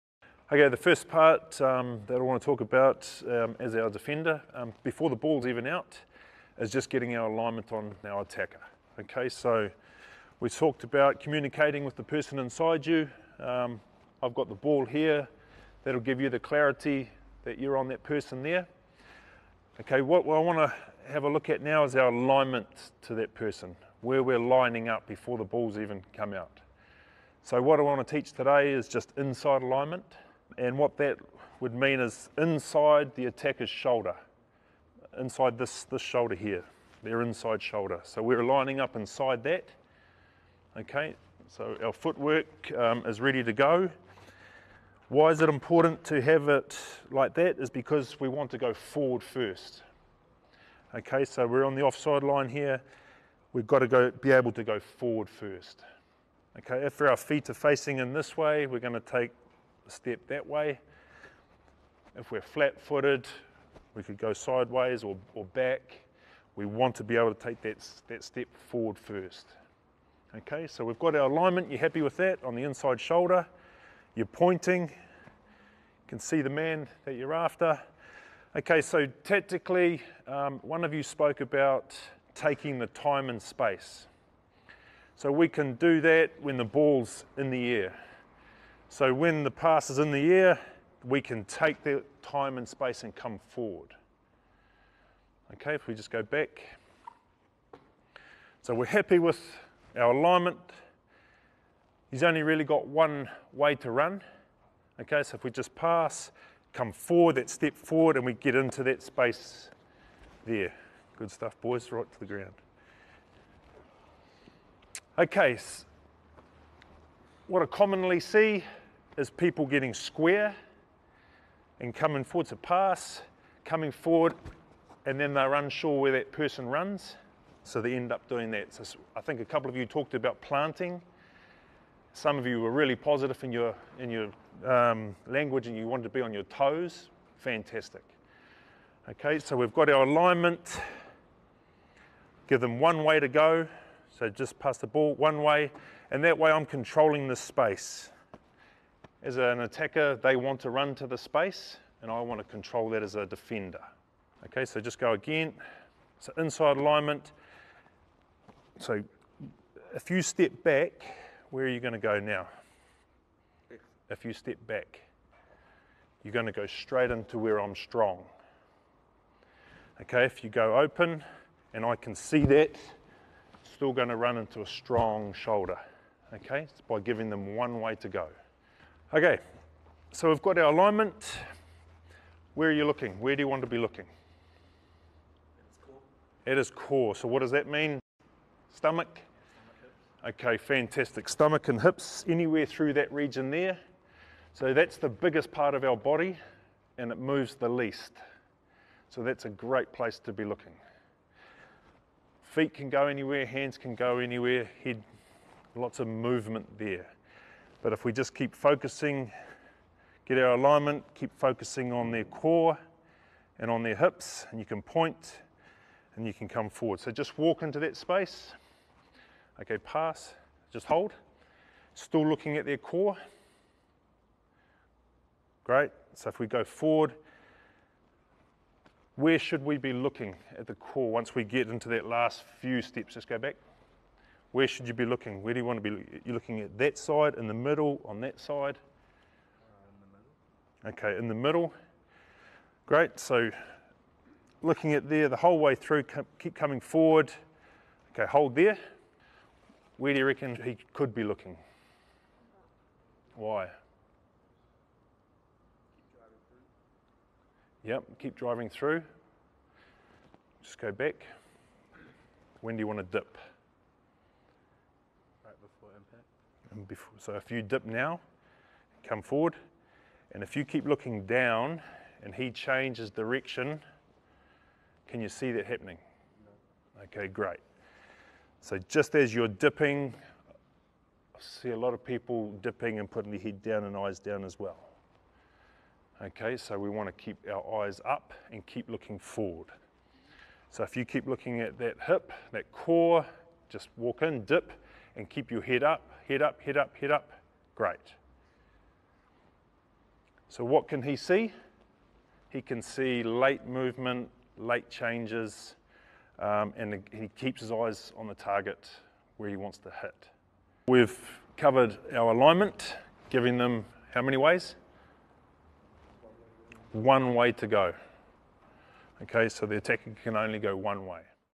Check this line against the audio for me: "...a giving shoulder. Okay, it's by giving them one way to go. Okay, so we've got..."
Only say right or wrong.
wrong.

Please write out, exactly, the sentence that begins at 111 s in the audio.
Good stuff, boys, right to the ground.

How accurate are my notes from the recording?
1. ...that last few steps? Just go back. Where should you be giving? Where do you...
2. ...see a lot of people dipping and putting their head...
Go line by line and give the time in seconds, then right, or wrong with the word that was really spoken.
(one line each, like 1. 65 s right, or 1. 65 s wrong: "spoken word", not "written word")
1. 231 s wrong: "looking", not "giving"
2. 281 s right.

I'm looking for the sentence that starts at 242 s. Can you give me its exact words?
Great, so looking at there the whole way through, keep coming forward.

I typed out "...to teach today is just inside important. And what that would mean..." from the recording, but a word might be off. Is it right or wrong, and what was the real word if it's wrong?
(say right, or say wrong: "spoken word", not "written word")
wrong: "alignment", not "important".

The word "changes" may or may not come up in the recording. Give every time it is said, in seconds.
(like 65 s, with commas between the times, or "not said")
272 s, 304 s.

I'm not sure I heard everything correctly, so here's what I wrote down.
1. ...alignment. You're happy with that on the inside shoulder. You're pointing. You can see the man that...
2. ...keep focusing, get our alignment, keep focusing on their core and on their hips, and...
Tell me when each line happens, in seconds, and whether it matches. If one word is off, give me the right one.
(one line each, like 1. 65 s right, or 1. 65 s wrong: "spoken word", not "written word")
1. 71 s right
2. 208 s right.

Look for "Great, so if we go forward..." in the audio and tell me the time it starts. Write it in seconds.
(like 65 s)
225 s.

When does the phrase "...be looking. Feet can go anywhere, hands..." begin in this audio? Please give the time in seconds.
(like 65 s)
200 s.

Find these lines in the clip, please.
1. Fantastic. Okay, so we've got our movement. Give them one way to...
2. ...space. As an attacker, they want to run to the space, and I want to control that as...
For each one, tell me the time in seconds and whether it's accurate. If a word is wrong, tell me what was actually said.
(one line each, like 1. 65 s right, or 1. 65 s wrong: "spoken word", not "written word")
1. 137 s wrong: "alignment", not "movement"
2. 147 s right.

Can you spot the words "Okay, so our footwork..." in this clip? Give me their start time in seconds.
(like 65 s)
40 s.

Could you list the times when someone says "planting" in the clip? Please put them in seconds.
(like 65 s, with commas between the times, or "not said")
130 s.